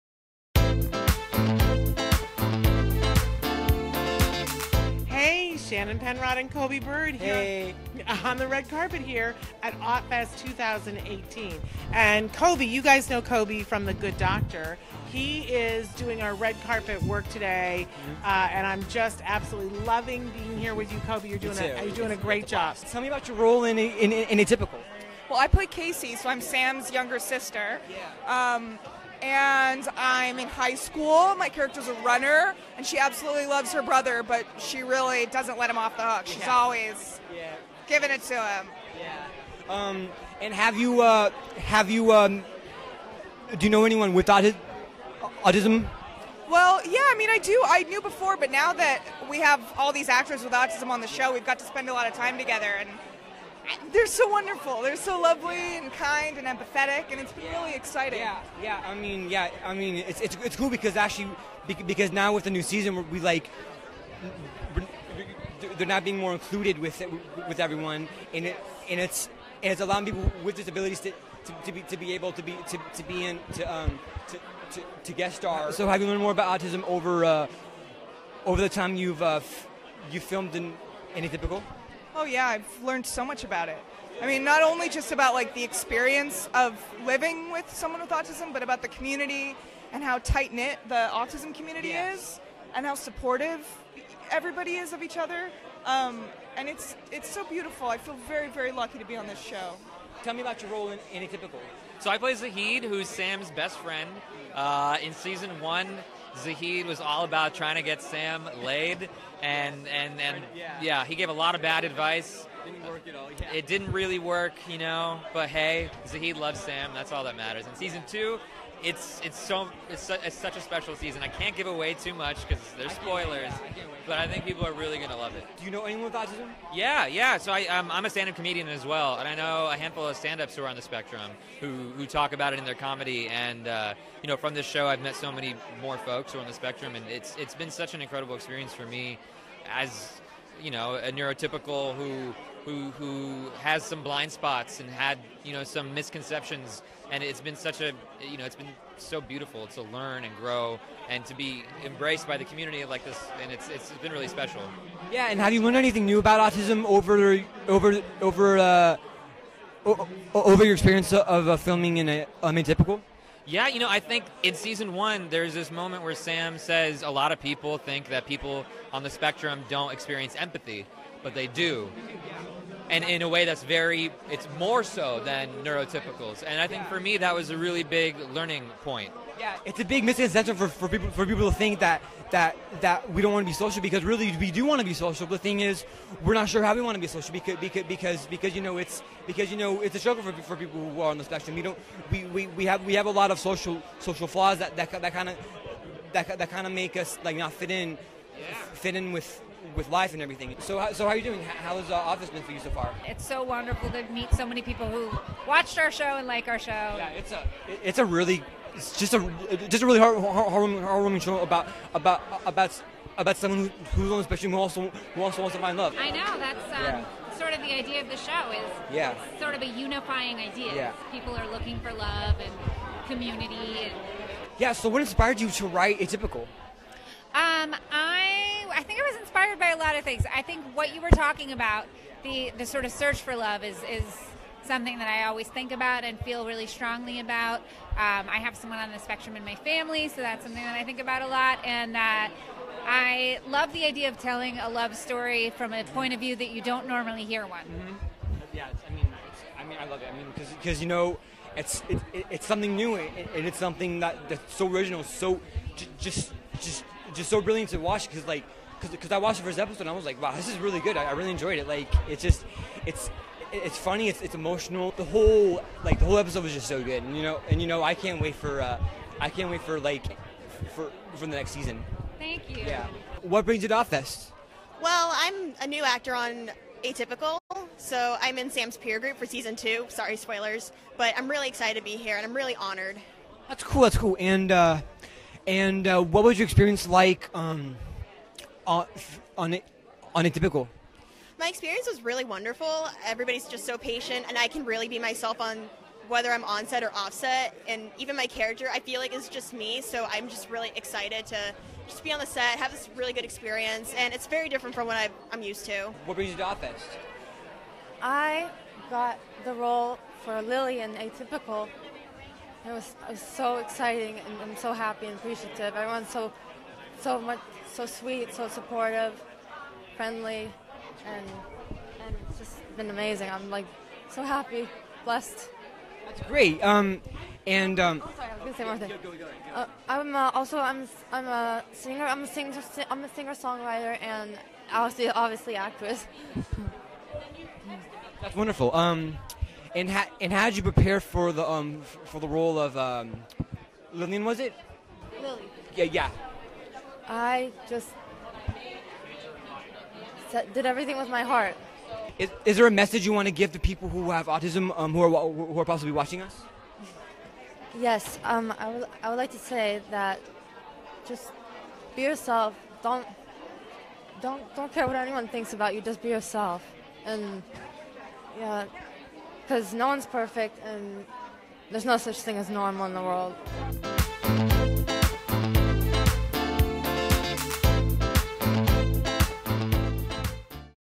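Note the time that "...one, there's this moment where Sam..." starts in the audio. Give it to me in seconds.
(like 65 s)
164 s.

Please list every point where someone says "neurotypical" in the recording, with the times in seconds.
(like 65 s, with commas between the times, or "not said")
141 s, 175 s.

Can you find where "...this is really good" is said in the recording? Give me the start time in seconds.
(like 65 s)
260 s.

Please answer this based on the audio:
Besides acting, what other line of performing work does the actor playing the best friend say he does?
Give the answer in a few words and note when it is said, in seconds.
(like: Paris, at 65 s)
stand-up comedian, at 128 s.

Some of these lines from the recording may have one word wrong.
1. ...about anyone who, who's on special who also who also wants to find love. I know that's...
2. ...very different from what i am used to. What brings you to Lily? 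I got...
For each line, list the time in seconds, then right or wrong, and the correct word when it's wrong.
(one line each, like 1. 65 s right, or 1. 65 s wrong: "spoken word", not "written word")
1. 213 s wrong: "someone", not "anyone"
2. 304 s wrong: "AutFest", not "Lily".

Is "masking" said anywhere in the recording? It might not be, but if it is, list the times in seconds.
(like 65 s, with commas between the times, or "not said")
not said.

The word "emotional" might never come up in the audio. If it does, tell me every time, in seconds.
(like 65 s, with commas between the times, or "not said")
264 s.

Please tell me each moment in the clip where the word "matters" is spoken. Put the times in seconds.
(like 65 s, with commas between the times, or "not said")
117 s.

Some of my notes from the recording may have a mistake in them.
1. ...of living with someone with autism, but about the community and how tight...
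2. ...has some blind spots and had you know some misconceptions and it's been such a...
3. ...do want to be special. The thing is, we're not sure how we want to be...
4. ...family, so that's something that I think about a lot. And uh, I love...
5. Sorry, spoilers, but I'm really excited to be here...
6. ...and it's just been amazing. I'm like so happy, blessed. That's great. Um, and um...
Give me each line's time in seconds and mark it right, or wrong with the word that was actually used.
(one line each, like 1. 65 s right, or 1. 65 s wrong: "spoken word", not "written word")
1. 86 s right
2. 143 s right
3. 184 s wrong: "social", not "special"
4. 239 s right
5. 279 s right
6. 322 s right.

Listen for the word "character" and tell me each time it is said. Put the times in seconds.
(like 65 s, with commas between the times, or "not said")
31 s, 298 s.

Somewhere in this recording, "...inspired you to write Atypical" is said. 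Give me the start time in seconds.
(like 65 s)
225 s.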